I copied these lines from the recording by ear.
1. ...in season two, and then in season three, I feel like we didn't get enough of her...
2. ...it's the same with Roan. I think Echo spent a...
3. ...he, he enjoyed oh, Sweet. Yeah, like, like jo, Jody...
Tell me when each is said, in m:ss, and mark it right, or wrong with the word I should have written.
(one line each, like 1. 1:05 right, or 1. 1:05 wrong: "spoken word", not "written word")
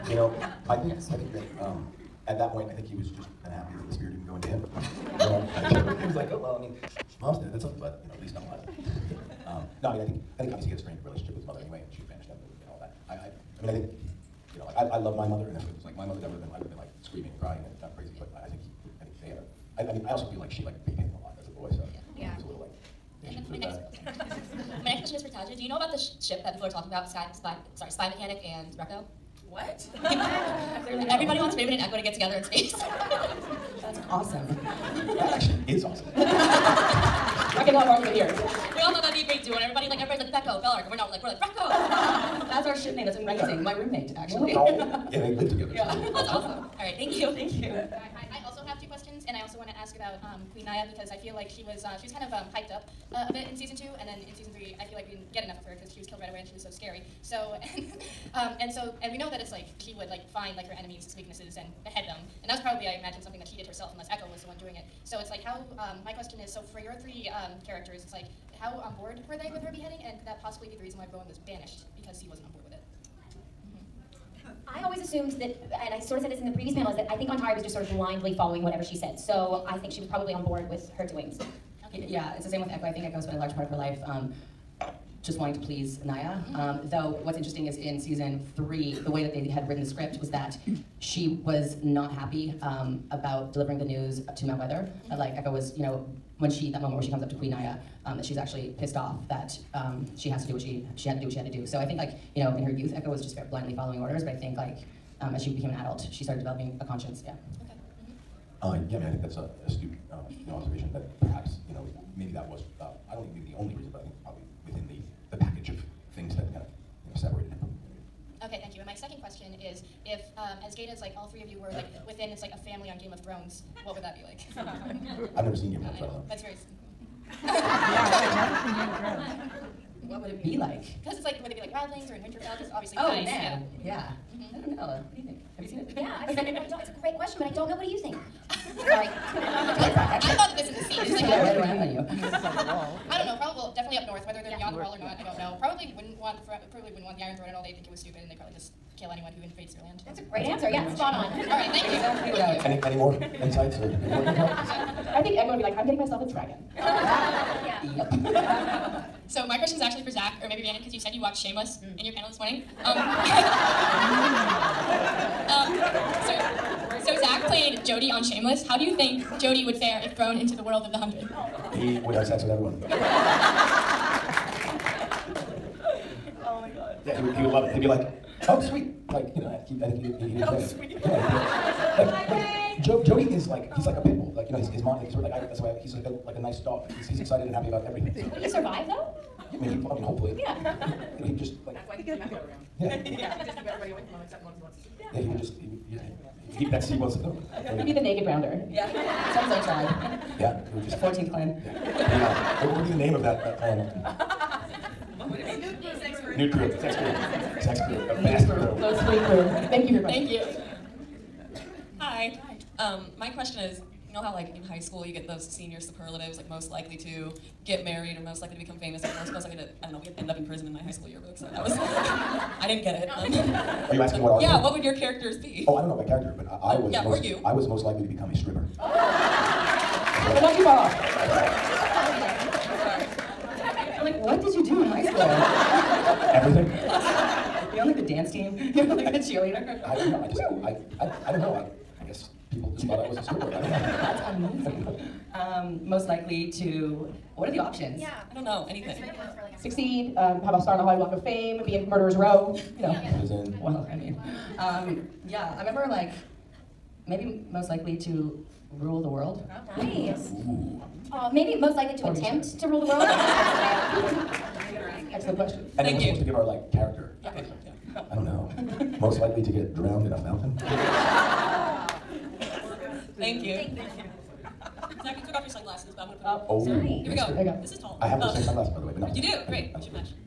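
1. 0:53 right
2. 1:22 wrong: "Echo", not "Roan"
3. 3:00 right.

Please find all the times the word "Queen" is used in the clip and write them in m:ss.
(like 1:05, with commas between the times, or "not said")
0:50, 1:37.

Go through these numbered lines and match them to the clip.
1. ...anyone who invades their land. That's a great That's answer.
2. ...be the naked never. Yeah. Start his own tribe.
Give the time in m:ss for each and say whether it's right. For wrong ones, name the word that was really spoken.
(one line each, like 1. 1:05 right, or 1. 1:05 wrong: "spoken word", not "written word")
1. 2:29 right
2. 3:17 wrong: "grounder", not "never".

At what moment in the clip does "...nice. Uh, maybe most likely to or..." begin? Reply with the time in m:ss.
4:19.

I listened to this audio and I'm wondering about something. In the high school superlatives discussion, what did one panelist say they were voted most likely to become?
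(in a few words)
a stripper.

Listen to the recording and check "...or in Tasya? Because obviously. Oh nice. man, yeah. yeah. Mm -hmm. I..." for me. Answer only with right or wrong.
wrong.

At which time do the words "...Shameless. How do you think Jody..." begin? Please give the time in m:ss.
2:48.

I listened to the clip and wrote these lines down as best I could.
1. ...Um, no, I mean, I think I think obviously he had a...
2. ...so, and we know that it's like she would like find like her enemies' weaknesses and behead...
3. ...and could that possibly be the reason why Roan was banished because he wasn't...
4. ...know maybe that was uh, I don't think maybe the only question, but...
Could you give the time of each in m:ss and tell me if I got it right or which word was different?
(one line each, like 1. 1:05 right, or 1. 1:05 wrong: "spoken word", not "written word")
1. 0:09 right
2. 0:58 right
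3. 1:10 right
4. 1:51 wrong: "reason", not "question".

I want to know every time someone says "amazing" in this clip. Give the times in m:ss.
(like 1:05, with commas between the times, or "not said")
0:43, 4:04.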